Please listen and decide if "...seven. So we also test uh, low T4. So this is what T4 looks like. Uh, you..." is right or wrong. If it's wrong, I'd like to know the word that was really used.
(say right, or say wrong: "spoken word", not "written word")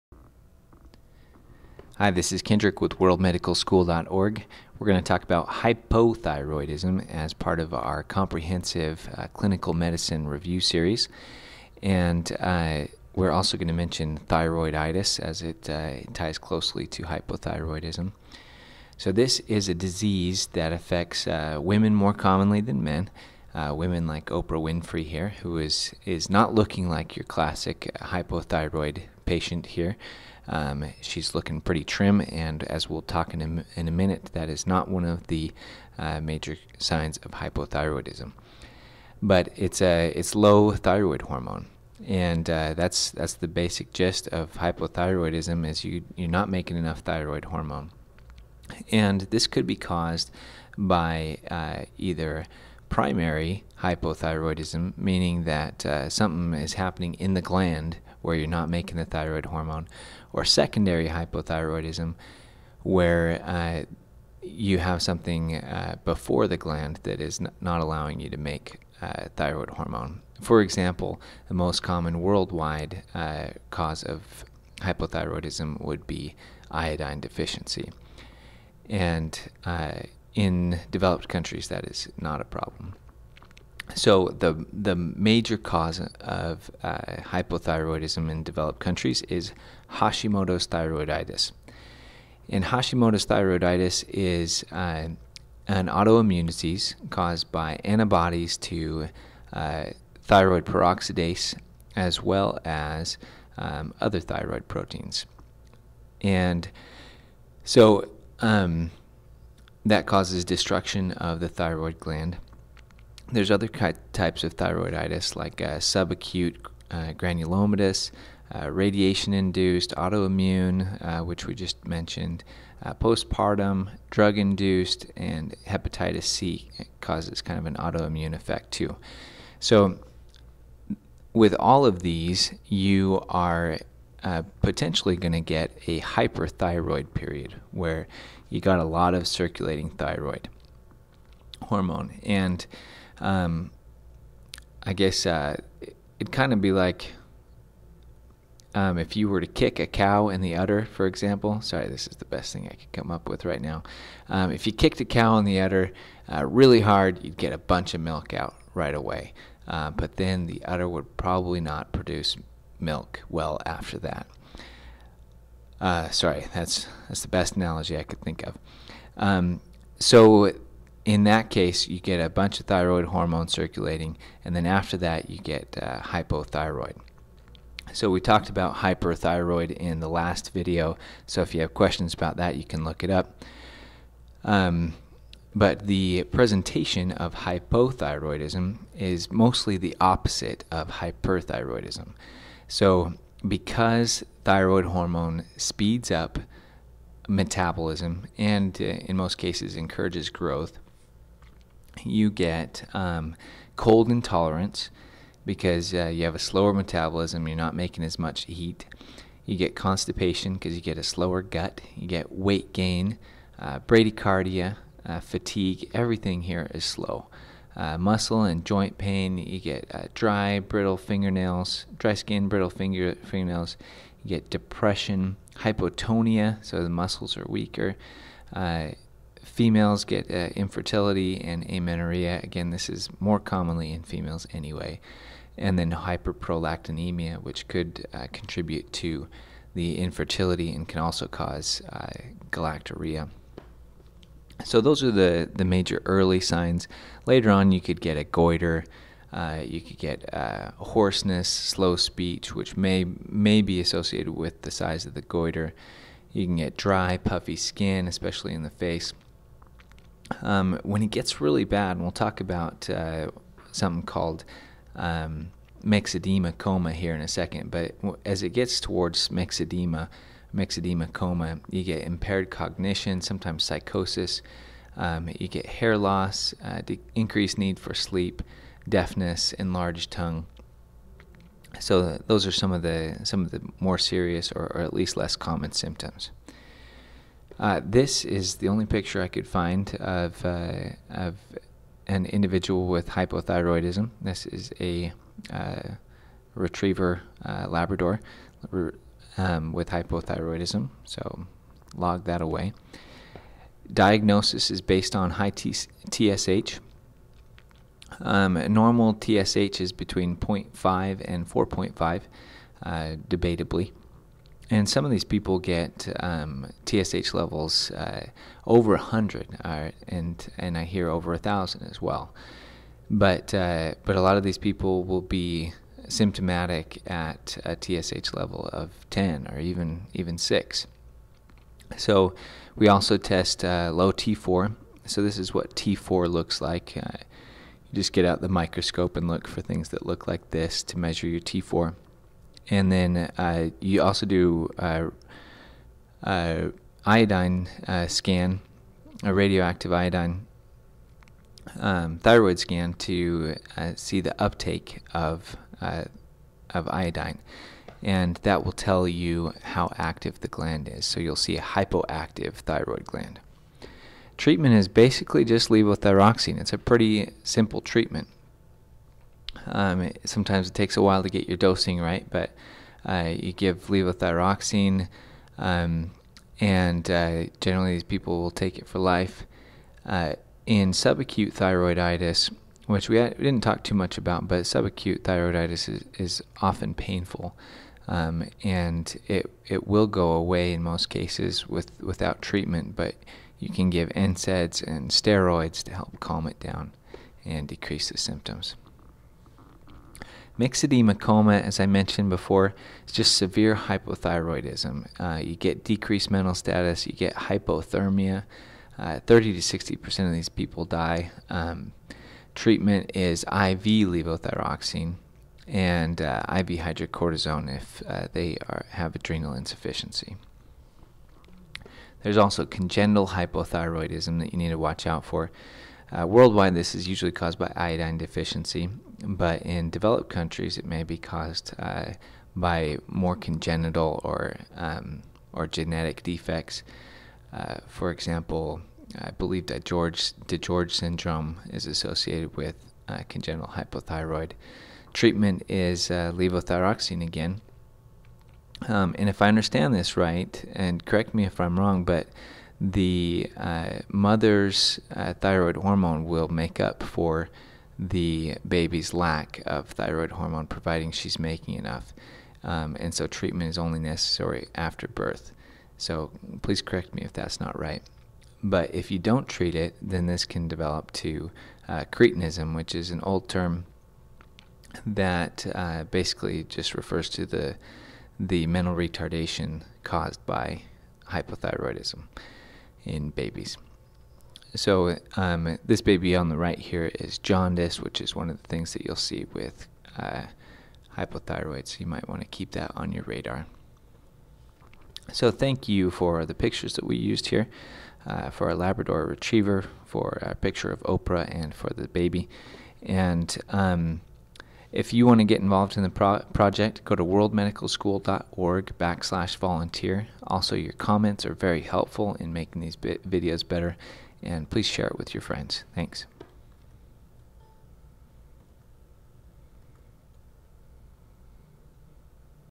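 wrong: "six", not "seven".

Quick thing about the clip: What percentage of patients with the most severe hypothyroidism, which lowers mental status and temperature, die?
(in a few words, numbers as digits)
30 to 60 percent.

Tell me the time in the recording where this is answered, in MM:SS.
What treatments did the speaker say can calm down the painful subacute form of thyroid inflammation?
06:34.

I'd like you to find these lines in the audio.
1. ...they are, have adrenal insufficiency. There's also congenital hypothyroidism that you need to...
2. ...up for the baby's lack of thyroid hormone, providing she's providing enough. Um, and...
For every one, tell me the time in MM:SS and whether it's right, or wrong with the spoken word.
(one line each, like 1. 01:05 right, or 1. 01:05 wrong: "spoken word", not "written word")
1. 06:58 right
2. 07:36 wrong: "making", not "providing".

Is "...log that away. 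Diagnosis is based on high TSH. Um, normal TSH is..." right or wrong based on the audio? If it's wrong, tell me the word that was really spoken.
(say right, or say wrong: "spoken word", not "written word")
right.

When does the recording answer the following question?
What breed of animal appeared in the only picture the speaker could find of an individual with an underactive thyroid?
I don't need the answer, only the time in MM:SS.
04:56.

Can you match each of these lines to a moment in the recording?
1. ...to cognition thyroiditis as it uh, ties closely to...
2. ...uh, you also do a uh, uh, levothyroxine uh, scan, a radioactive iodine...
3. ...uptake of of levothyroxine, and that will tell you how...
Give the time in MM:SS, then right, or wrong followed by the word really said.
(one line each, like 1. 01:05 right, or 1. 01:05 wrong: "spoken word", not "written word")
1. 00:13 wrong: "mention", not "cognition"
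2. 05:43 wrong: "iodine", not "levothyroxine"
3. 05:54 wrong: "iodine", not "levothyroxine".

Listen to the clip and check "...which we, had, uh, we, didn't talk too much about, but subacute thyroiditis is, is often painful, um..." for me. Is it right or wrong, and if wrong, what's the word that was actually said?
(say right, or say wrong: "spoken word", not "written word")
right.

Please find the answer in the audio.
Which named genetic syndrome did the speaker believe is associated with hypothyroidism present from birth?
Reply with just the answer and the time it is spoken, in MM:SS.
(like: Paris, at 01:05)
DiGeorge syndrome, at 07:20.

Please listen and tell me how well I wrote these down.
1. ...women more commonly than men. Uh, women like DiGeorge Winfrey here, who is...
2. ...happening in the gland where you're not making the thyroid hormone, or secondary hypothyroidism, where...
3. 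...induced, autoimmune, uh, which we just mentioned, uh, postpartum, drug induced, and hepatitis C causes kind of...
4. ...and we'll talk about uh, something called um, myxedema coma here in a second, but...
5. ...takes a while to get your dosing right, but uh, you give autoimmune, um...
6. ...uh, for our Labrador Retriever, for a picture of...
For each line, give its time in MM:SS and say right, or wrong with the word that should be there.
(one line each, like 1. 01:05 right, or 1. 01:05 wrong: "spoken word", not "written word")
1. 00:21 wrong: "Oprah", not "DiGeorge"
2. 00:56 right
3. 01:59 right
4. 04:21 right
5. 06:10 wrong: "levothyroxine", not "autoimmune"
6. 08:18 right.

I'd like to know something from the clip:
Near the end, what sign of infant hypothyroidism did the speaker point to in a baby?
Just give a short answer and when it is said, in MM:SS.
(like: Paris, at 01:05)
Jaundice, at 08:07.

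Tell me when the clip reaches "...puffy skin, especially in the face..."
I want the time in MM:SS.
04:17.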